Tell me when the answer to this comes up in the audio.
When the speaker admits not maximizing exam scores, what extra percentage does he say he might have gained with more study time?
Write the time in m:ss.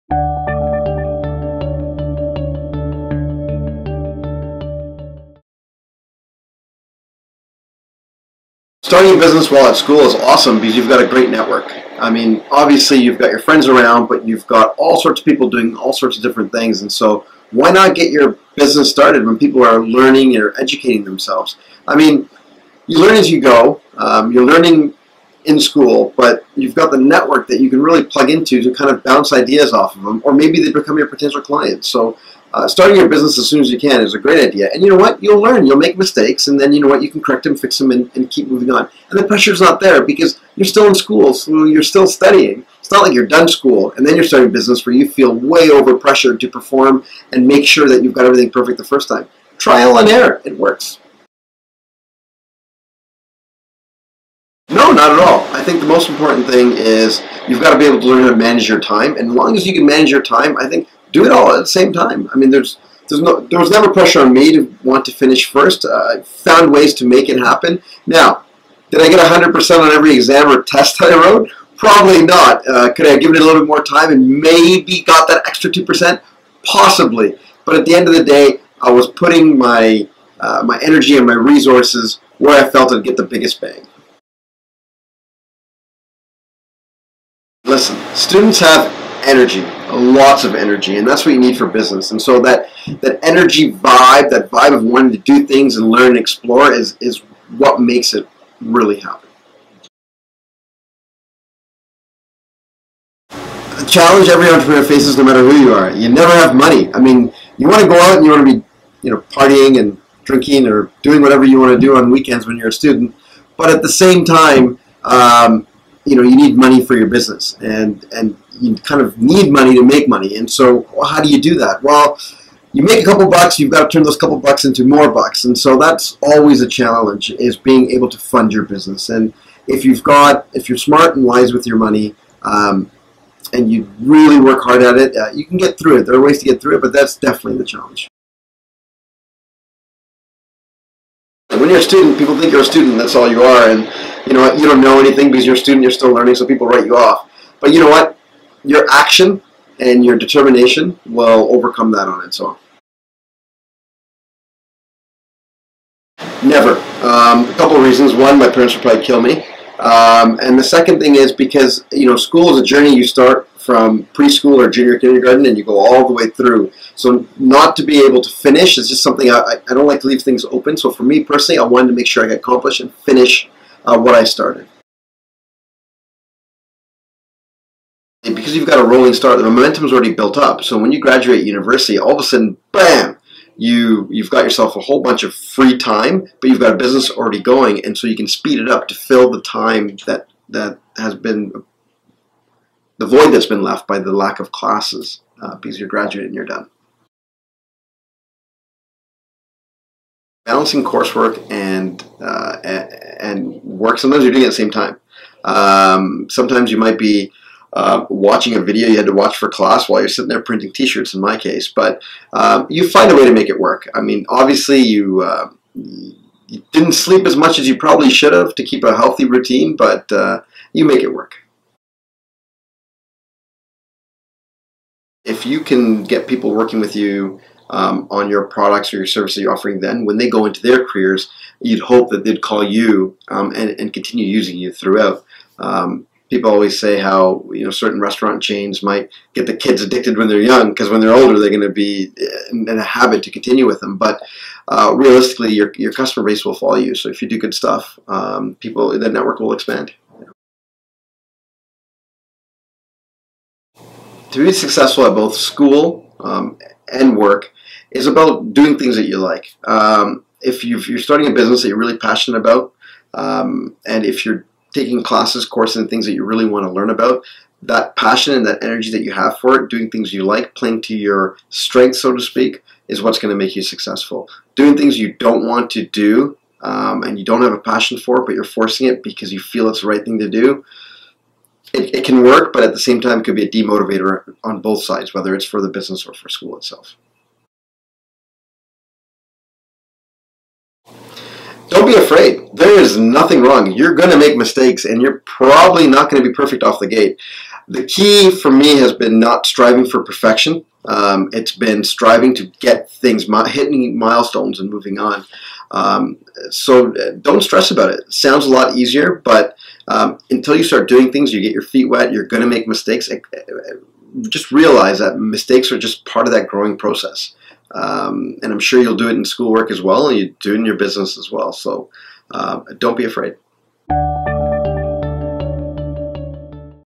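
1:15.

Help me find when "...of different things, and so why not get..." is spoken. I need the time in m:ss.
0:16.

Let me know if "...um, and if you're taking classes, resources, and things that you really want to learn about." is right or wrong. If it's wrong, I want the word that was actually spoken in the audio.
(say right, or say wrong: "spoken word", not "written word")
wrong: "courses", not "resources".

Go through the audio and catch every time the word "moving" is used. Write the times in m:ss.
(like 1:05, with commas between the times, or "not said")
0:38, 5:04.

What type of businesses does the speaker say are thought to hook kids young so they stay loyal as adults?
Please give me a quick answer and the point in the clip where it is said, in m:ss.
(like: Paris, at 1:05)
restaurant chains, at 3:58.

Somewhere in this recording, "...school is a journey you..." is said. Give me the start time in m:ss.
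2:42.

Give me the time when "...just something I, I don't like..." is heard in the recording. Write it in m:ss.
2:48.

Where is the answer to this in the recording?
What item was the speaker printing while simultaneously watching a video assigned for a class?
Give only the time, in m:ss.
3:30.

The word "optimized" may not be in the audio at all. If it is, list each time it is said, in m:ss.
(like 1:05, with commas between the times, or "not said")
not said.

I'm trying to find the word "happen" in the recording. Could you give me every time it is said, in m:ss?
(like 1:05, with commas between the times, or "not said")
1:07, 1:38.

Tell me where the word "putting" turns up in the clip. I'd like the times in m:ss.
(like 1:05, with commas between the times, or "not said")
1:19.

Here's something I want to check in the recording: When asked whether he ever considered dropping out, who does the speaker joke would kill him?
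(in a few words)
my parents.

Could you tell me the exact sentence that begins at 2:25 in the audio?
You're still learning, so people write you off.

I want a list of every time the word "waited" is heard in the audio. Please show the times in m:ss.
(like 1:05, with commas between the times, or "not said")
not said.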